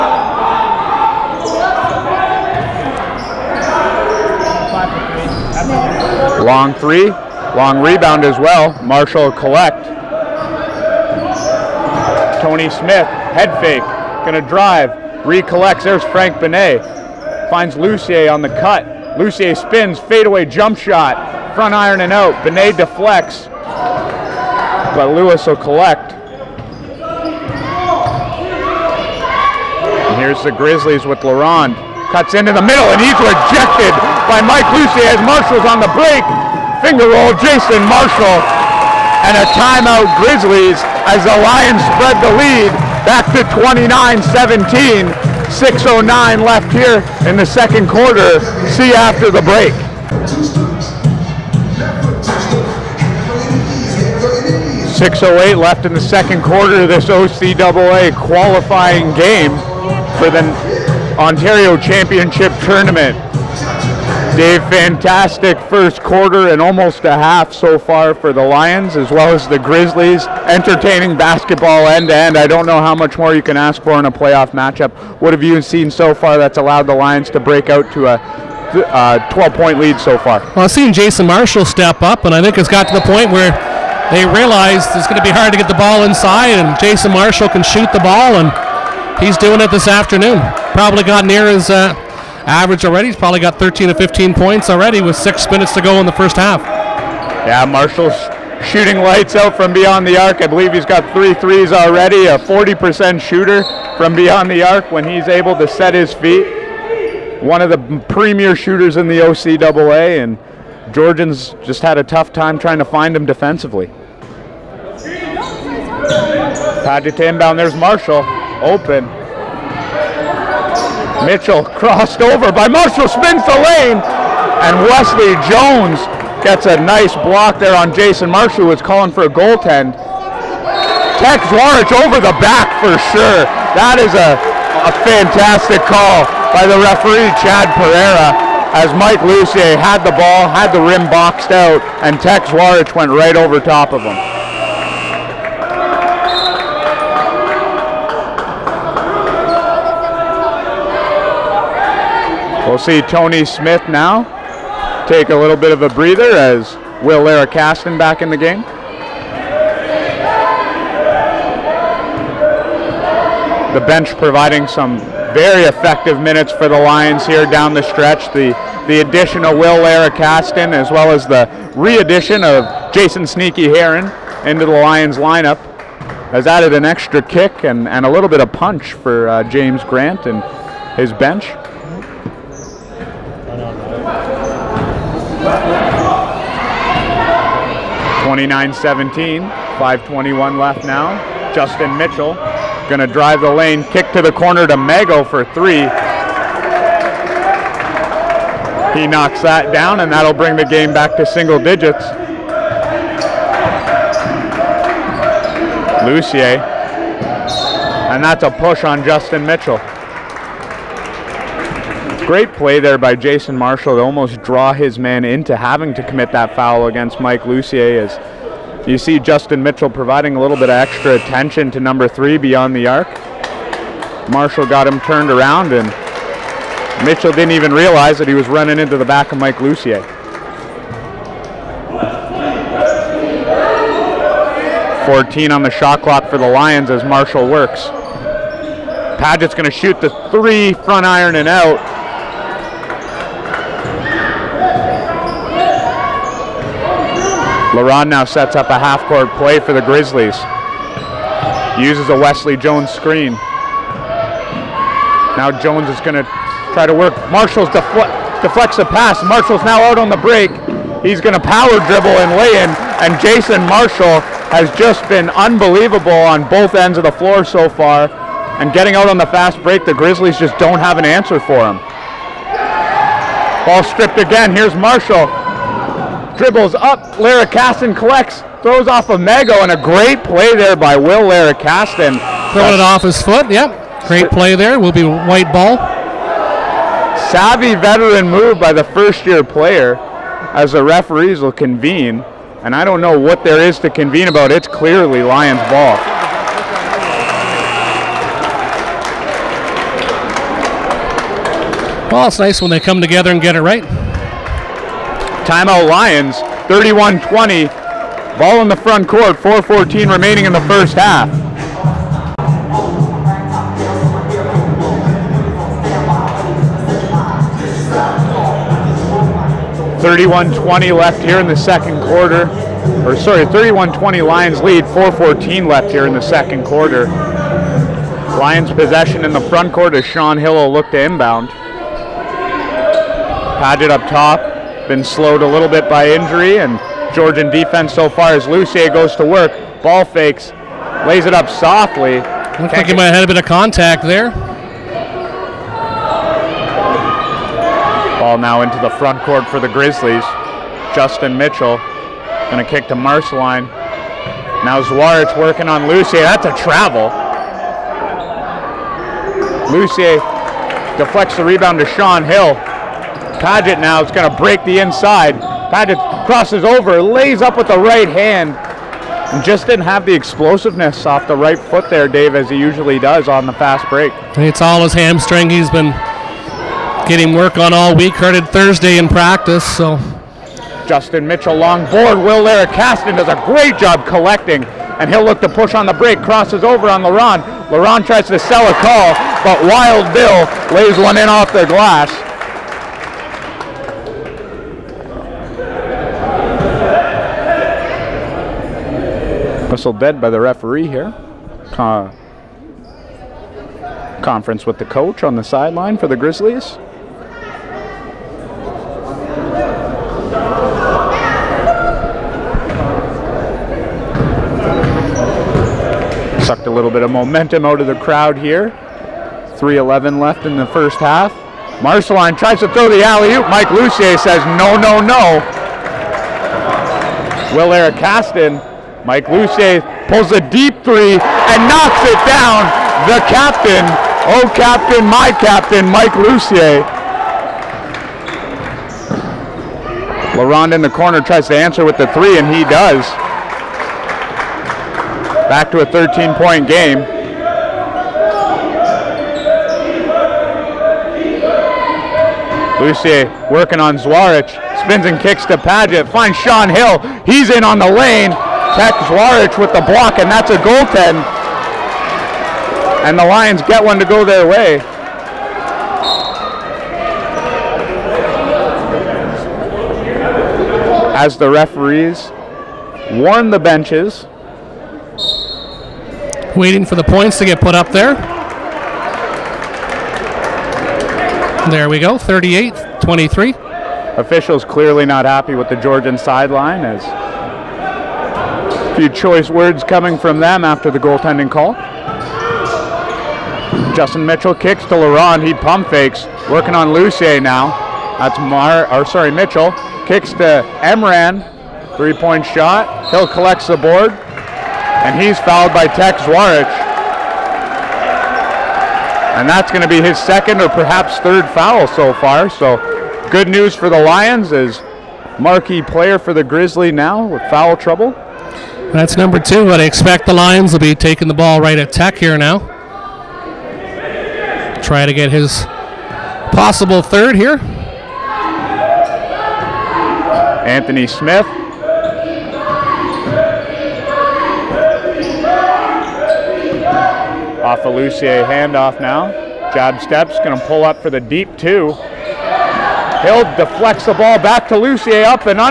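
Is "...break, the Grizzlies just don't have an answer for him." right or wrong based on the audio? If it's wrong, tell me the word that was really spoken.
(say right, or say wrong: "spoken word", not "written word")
right.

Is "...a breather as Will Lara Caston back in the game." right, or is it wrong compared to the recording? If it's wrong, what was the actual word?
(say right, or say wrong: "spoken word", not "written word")
right.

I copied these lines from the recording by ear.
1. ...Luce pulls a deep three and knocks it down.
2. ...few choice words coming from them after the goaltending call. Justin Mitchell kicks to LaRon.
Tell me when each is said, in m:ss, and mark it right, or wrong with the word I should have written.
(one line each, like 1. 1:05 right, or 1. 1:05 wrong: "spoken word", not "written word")
1. 7:09 right
2. 8:08 right.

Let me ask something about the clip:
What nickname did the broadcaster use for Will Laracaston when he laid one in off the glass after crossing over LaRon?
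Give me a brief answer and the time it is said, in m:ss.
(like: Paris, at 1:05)
Wild Bill, at 6:29.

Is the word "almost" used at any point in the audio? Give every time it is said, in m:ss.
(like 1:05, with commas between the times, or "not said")
1:06, 3:34.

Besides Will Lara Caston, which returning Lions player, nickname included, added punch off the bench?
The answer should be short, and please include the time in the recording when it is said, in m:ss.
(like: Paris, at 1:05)
Jason Sneaky Heron, at 2:52.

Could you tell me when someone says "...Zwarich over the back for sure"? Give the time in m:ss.
2:11.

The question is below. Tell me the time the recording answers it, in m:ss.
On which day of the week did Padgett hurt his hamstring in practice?
6:18.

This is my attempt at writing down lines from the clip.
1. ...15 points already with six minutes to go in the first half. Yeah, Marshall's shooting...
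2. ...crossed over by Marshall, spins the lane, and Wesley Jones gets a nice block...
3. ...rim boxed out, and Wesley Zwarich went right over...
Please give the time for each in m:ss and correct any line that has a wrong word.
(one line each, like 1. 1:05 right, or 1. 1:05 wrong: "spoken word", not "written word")
1. 1:33 right
2. 2:01 right
3. 2:20 wrong: "Tex", not "Wesley".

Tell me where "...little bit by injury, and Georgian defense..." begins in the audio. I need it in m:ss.
5:35.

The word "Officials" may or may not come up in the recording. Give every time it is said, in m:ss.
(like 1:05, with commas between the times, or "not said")
8:04.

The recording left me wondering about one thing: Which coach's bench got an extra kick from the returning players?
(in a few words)
James Grant.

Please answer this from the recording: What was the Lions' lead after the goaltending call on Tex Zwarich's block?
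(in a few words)
38-23.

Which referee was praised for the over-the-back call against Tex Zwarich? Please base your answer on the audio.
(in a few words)
Chad Pereira.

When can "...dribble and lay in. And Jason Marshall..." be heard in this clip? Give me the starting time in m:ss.
4:21.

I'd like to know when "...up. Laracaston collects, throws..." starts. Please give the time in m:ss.
4:36.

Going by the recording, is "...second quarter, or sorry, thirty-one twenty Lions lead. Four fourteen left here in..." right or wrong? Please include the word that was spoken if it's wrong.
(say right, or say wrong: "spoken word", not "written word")
right.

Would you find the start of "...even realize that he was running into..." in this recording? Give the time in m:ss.
3:47.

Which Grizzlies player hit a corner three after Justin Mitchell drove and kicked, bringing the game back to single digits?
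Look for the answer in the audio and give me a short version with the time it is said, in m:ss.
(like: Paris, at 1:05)
Mago, at 3:14.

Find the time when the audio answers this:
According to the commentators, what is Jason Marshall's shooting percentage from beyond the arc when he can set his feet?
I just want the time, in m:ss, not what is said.
1:42.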